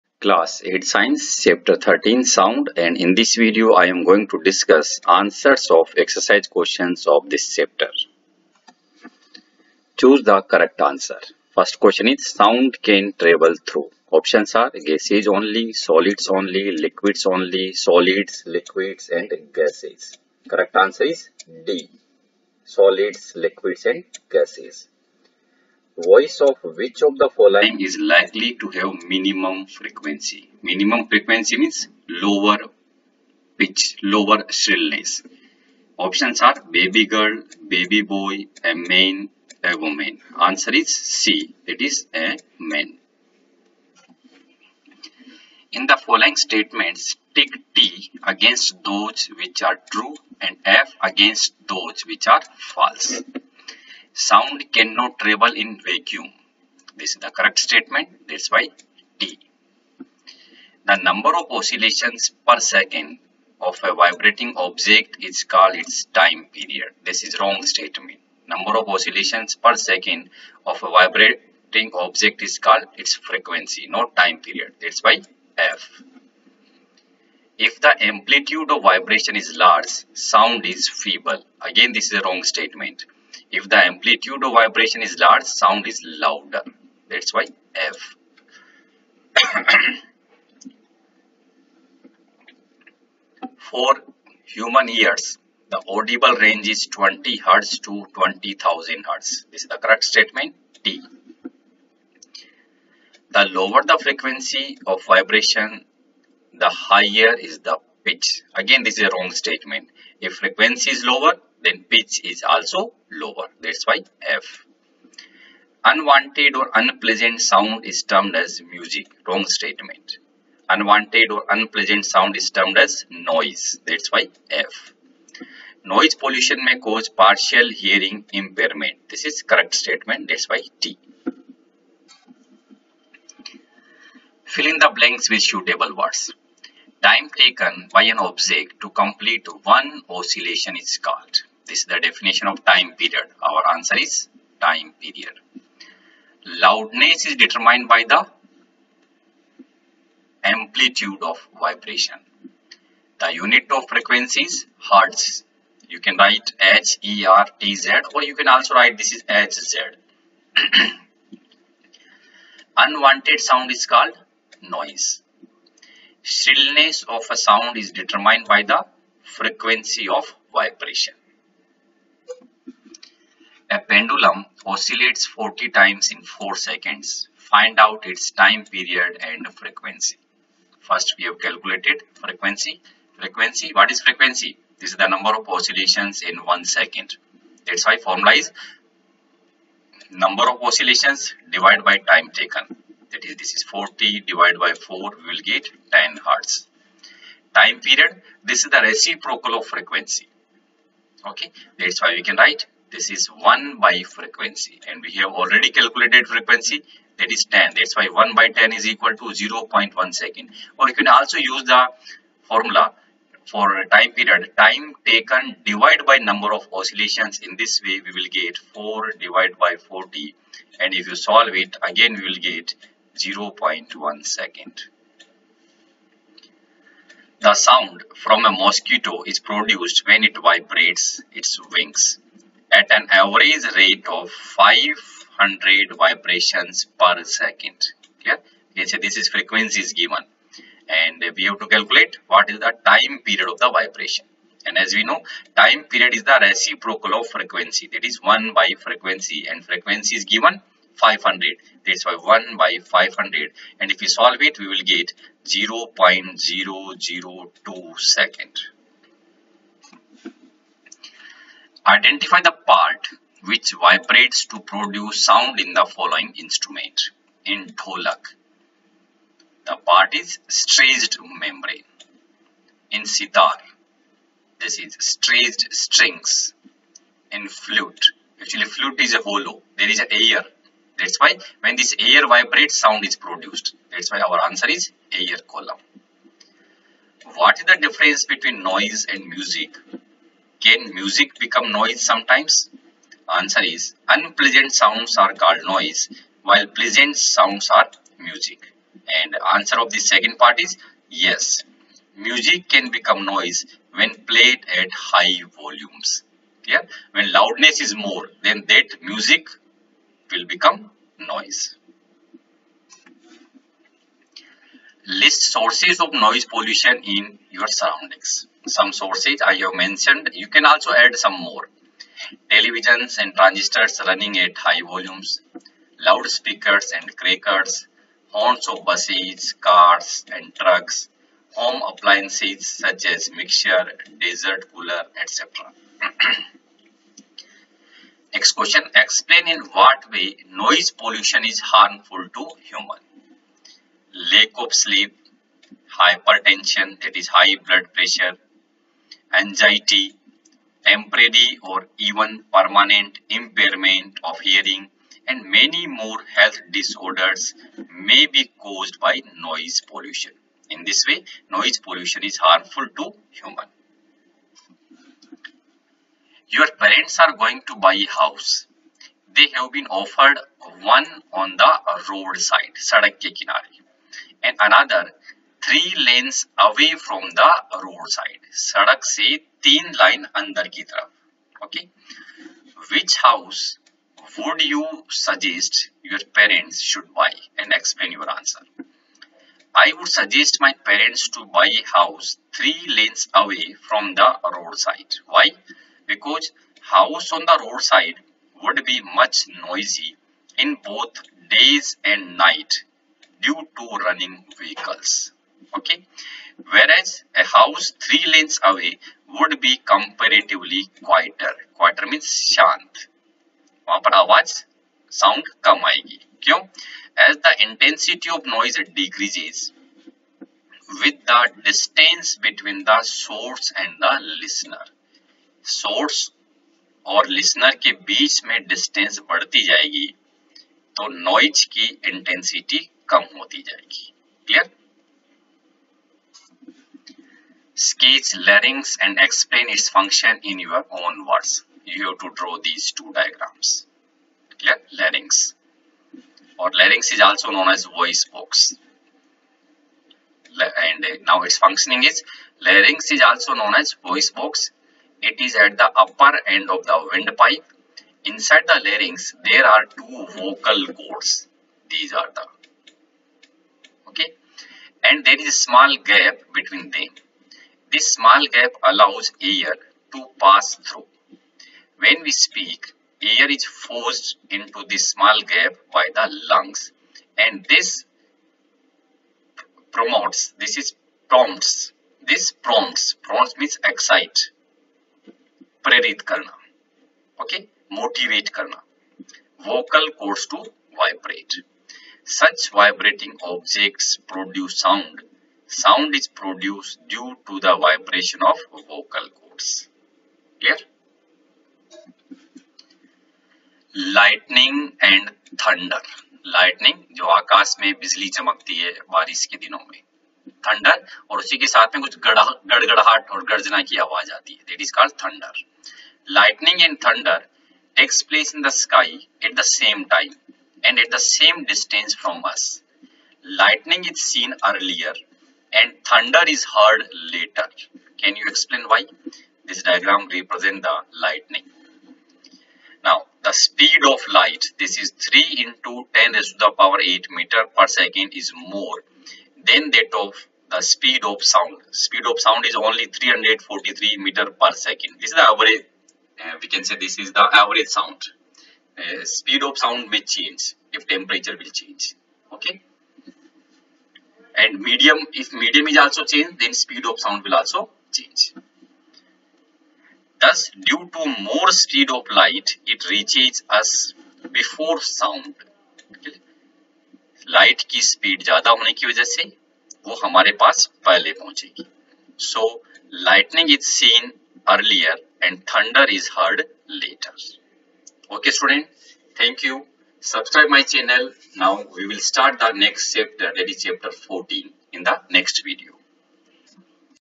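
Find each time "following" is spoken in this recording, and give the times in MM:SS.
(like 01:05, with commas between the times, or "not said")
00:27, 00:45, 04:25.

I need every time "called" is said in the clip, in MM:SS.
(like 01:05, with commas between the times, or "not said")
01:05, 01:12, 02:21, 02:43, 04:55, 08:34.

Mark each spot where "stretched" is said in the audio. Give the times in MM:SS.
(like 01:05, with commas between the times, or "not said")
04:30, 04:35.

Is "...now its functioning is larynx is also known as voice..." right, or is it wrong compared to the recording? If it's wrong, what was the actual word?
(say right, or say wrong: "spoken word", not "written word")
right.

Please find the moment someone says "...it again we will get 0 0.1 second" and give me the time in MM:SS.
03:41.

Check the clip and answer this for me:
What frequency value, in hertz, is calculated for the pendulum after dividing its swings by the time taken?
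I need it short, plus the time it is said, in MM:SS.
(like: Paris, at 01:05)
10 hertz, at 03:15.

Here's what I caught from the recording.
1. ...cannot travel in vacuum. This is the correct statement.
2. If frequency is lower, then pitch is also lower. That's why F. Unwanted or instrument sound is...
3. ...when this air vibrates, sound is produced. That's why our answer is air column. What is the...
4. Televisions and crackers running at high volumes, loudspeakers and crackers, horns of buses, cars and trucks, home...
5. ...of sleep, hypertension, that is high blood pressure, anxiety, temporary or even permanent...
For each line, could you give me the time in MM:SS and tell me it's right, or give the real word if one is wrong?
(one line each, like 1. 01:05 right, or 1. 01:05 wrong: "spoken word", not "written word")
1. 00:54 right
2. 01:50 wrong: "unpleasant", not "instrument"
3. 04:41 right
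4. 05:22 wrong: "transistors", not "crackers"
5. 05:44 right.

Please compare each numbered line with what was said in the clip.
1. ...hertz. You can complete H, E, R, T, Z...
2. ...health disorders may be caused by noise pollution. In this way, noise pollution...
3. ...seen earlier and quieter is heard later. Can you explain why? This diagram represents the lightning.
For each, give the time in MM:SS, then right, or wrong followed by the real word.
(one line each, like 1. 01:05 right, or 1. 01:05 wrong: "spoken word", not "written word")
1. 02:34 wrong: "write", not "complete"
2. 05:56 right
3. 08:44 wrong: "thunder", not "quieter".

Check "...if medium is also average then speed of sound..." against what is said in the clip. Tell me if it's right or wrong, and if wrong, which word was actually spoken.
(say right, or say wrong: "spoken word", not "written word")
wrong: "change", not "average".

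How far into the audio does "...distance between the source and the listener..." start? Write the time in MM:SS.
07:01.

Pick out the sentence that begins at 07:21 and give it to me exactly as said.
You have to draw these two diagrams.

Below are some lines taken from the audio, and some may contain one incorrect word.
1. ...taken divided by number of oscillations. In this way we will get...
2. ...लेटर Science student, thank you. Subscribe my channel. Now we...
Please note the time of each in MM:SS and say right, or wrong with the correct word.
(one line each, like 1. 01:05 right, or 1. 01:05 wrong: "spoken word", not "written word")
1. 03:35 right
2. 09:36 wrong: "Okay", not "Science".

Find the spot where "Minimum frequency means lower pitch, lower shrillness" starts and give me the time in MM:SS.
00:30.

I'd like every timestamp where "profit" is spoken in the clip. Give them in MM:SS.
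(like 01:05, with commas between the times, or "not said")
not said.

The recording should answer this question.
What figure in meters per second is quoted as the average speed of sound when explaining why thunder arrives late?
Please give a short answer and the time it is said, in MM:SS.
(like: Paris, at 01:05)
343, at 09:03.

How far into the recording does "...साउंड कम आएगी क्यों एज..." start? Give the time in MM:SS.
06:55.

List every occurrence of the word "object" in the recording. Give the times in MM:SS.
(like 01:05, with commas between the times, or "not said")
01:04, 01:11, 02:18, 08:13.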